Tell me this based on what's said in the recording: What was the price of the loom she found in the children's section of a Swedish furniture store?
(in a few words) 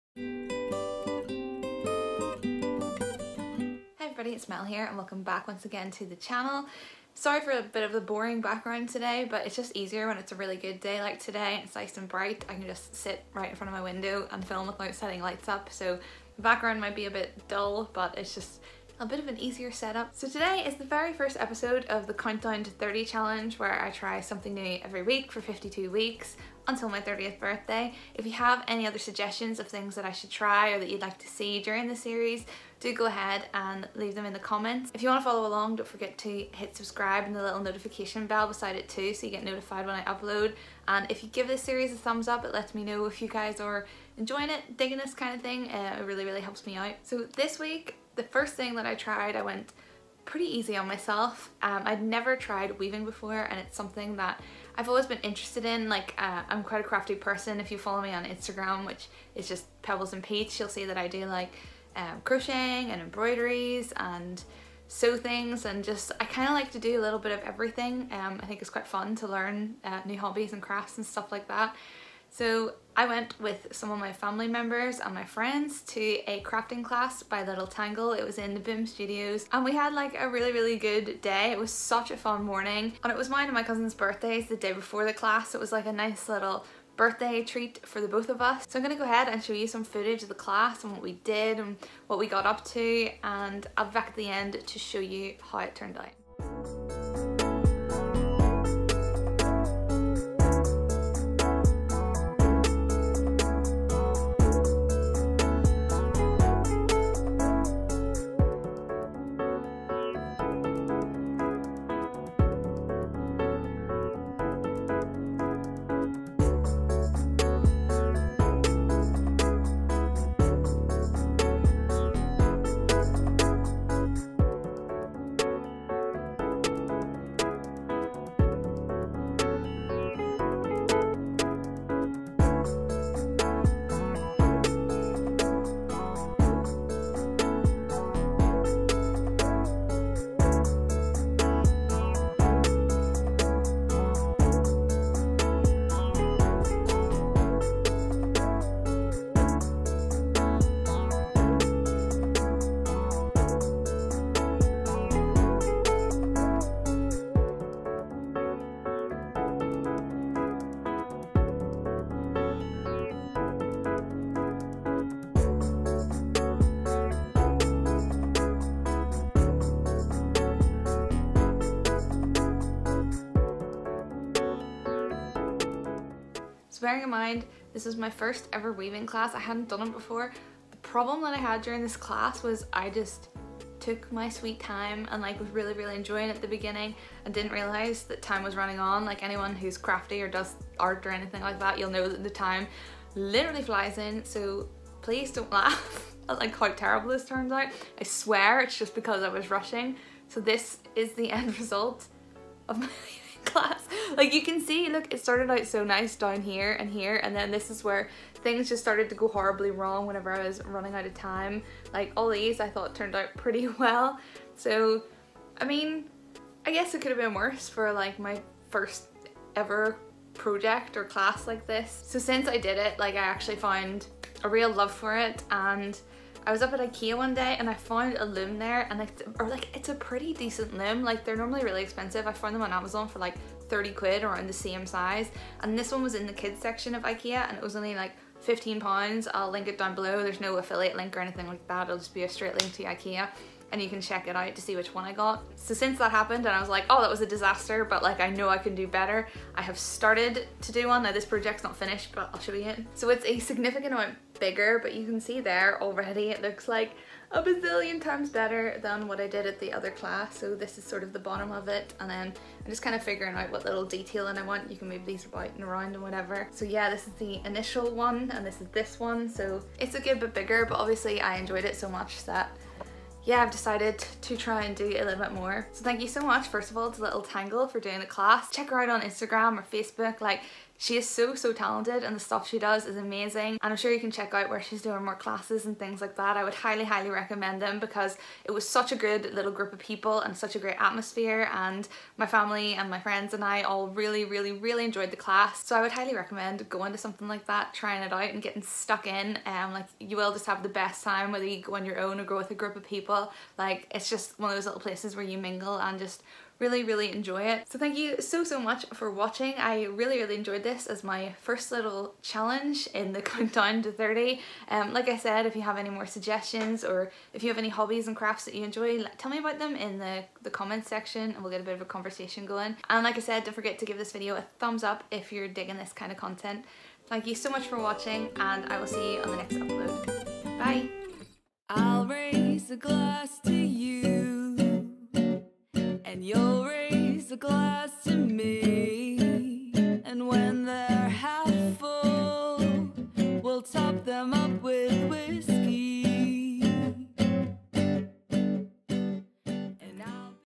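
15 pounds.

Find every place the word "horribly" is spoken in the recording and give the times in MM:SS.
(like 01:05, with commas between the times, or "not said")
03:29.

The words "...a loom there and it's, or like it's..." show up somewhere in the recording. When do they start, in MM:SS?
03:48.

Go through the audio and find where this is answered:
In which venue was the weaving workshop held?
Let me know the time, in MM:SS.
01:18.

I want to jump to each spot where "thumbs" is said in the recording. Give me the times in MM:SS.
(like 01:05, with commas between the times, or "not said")
00:41, 05:24.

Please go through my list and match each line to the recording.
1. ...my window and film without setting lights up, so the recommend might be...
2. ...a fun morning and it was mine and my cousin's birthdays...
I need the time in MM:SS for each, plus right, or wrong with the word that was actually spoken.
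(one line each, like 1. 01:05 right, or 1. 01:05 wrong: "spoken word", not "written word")
1. 00:13 wrong: "background", not "recommend"
2. 01:22 right.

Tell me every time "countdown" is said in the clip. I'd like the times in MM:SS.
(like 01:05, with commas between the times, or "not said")
00:22, 05:13.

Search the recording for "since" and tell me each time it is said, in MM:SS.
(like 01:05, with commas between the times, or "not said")
03:42, 04:05.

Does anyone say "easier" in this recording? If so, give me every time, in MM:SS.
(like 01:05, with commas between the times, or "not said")
00:09, 00:19.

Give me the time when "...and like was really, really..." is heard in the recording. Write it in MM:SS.
03:05.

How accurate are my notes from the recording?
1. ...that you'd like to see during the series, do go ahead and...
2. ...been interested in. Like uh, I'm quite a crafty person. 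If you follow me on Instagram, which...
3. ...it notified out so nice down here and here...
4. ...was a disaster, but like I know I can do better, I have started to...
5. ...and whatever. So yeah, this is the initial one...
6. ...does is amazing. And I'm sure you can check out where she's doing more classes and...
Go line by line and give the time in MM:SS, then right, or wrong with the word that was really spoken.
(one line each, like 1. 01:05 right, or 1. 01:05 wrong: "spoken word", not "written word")
1. 00:30 right
2. 00:55 right
3. 03:25 wrong: "started", not "notified"
4. 04:07 right
5. 04:25 right
6. 04:42 right.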